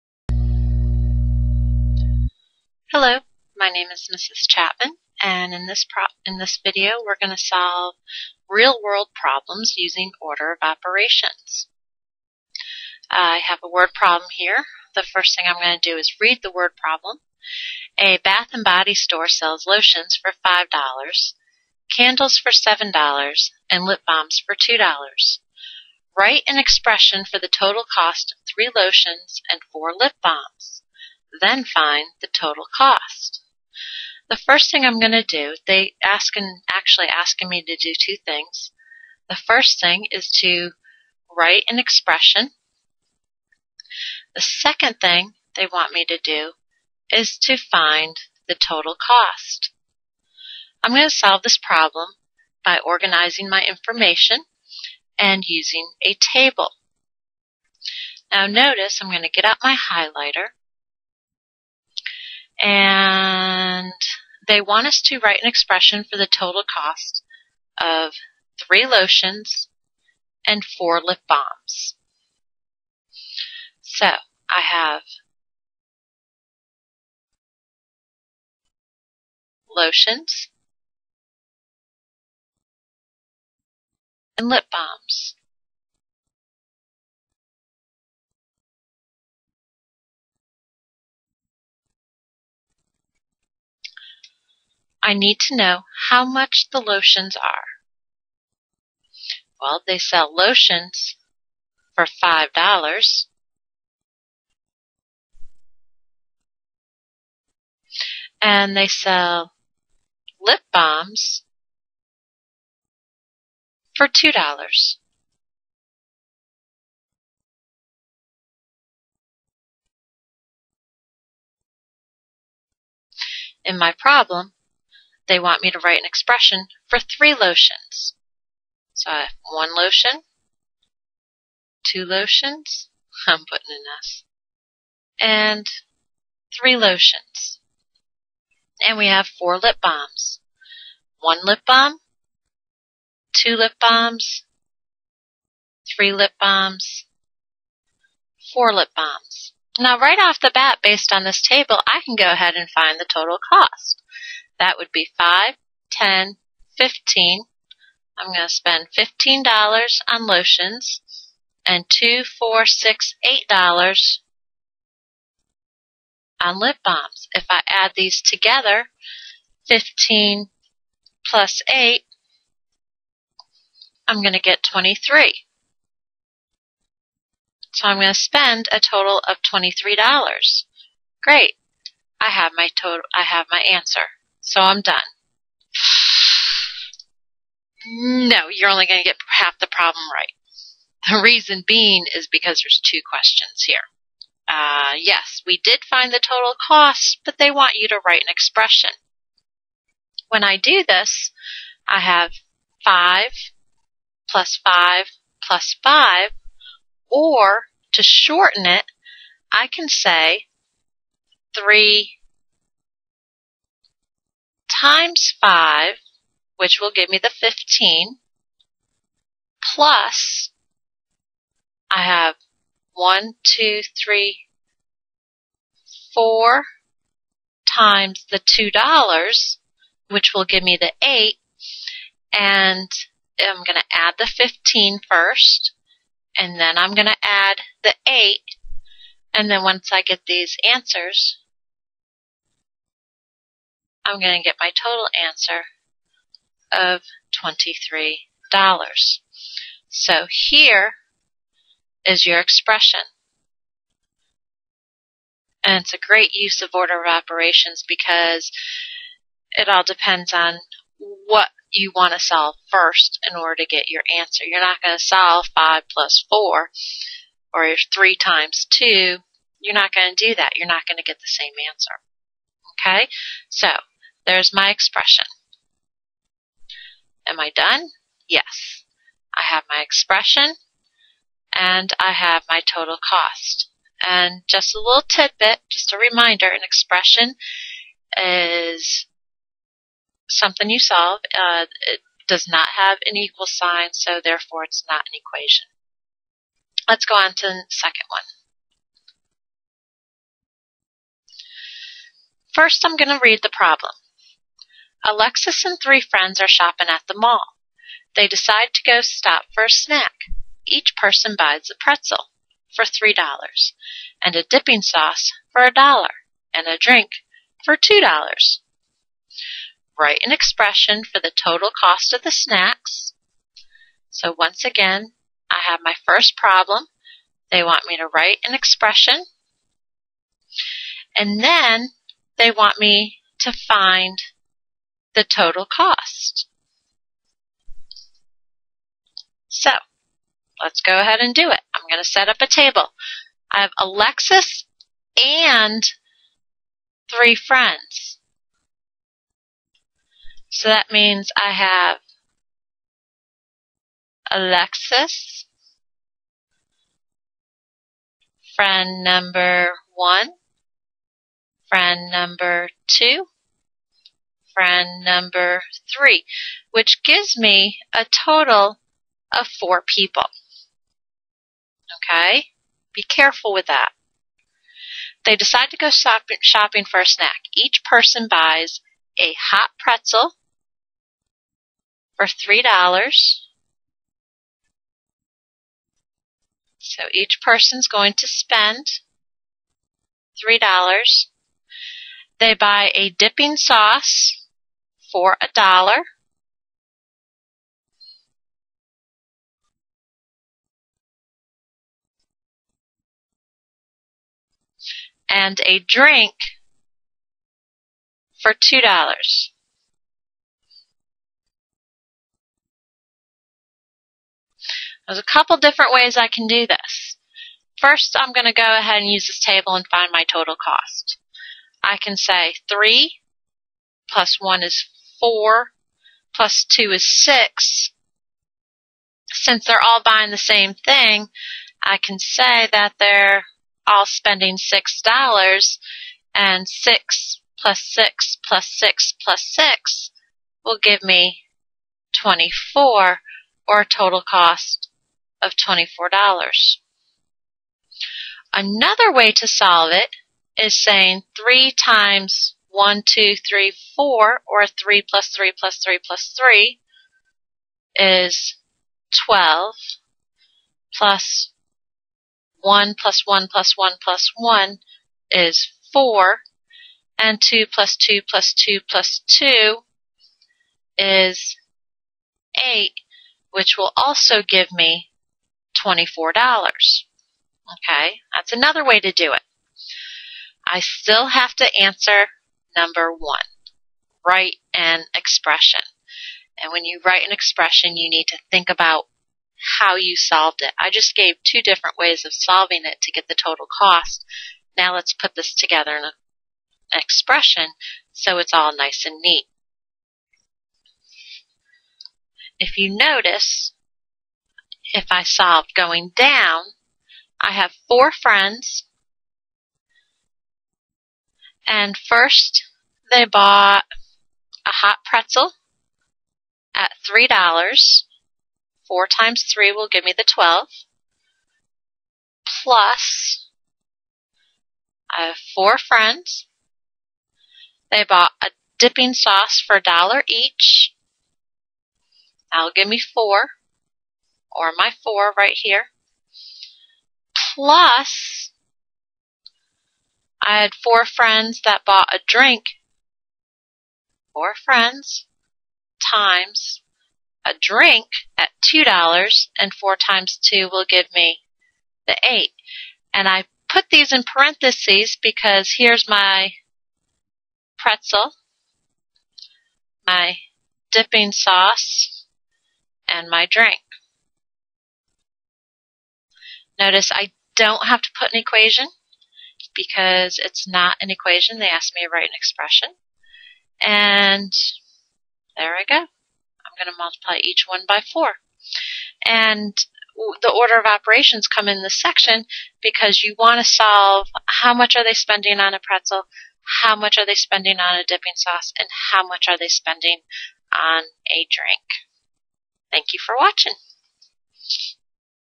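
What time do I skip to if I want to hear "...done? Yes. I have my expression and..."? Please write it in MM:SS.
04:37.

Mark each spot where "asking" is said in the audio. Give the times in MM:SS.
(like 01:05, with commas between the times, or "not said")
00:37.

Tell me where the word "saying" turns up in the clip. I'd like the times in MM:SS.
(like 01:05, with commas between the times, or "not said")
07:30.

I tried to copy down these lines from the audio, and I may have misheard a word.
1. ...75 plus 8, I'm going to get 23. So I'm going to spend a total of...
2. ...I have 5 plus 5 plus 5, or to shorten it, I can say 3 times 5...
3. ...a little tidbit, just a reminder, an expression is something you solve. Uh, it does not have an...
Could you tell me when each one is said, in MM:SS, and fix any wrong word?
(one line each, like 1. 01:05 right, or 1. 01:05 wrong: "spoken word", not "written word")
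1. 02:49 wrong: "15", not "75"
2. 03:21 right
3. 04:44 right.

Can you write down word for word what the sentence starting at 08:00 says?
I still have to answer number one write an expression.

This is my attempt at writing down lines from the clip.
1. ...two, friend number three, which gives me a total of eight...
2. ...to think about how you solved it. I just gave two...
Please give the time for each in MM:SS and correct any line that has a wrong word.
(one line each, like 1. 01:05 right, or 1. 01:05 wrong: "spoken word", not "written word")
1. 06:02 wrong: "four", not "eight"
2. 08:08 right.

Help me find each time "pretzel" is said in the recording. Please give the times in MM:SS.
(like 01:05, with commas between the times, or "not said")
05:11, 06:19, 08:35, 09:17, 09:45.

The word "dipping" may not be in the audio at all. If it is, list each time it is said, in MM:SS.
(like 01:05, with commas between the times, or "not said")
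05:14, 06:33, 08:48, 09:20, 09:48.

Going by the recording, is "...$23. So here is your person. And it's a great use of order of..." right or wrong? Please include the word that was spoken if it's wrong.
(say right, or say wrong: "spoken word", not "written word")
wrong: "expression", not "person".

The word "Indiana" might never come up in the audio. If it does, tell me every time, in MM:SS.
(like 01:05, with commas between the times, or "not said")
not said.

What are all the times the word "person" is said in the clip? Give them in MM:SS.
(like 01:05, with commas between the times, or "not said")
05:10, 06:17, 06:27.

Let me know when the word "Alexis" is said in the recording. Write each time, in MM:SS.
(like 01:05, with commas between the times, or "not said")
05:05, 05:43, 05:54.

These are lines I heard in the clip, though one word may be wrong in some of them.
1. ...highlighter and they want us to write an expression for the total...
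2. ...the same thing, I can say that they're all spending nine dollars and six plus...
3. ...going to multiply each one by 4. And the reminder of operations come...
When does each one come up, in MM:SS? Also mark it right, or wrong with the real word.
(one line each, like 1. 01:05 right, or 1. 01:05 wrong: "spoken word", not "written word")
1. 00:59 right
2. 07:10 wrong: "six", not "nine"
3. 09:36 wrong: "order", not "reminder".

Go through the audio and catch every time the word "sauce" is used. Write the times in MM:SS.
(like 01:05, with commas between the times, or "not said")
05:14, 06:33, 08:49, 09:21, 09:48.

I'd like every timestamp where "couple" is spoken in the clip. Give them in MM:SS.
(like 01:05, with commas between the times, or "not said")
06:55.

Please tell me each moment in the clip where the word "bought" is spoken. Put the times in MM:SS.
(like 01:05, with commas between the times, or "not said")
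08:33, 08:48, 09:01.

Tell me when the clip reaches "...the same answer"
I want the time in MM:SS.
04:31.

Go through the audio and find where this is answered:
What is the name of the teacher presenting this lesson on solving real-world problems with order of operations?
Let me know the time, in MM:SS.
00:04.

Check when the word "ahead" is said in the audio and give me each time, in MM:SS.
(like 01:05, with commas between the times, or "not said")
02:32, 05:40, 06:58.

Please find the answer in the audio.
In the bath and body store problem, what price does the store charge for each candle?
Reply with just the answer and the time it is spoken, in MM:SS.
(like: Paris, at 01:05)
$7, at 00:22.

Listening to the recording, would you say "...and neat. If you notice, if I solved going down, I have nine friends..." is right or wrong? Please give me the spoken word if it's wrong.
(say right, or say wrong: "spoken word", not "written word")
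wrong: "four", not "nine".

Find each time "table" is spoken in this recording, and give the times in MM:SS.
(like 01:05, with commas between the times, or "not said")
00:56, 02:31, 05:42, 06:59.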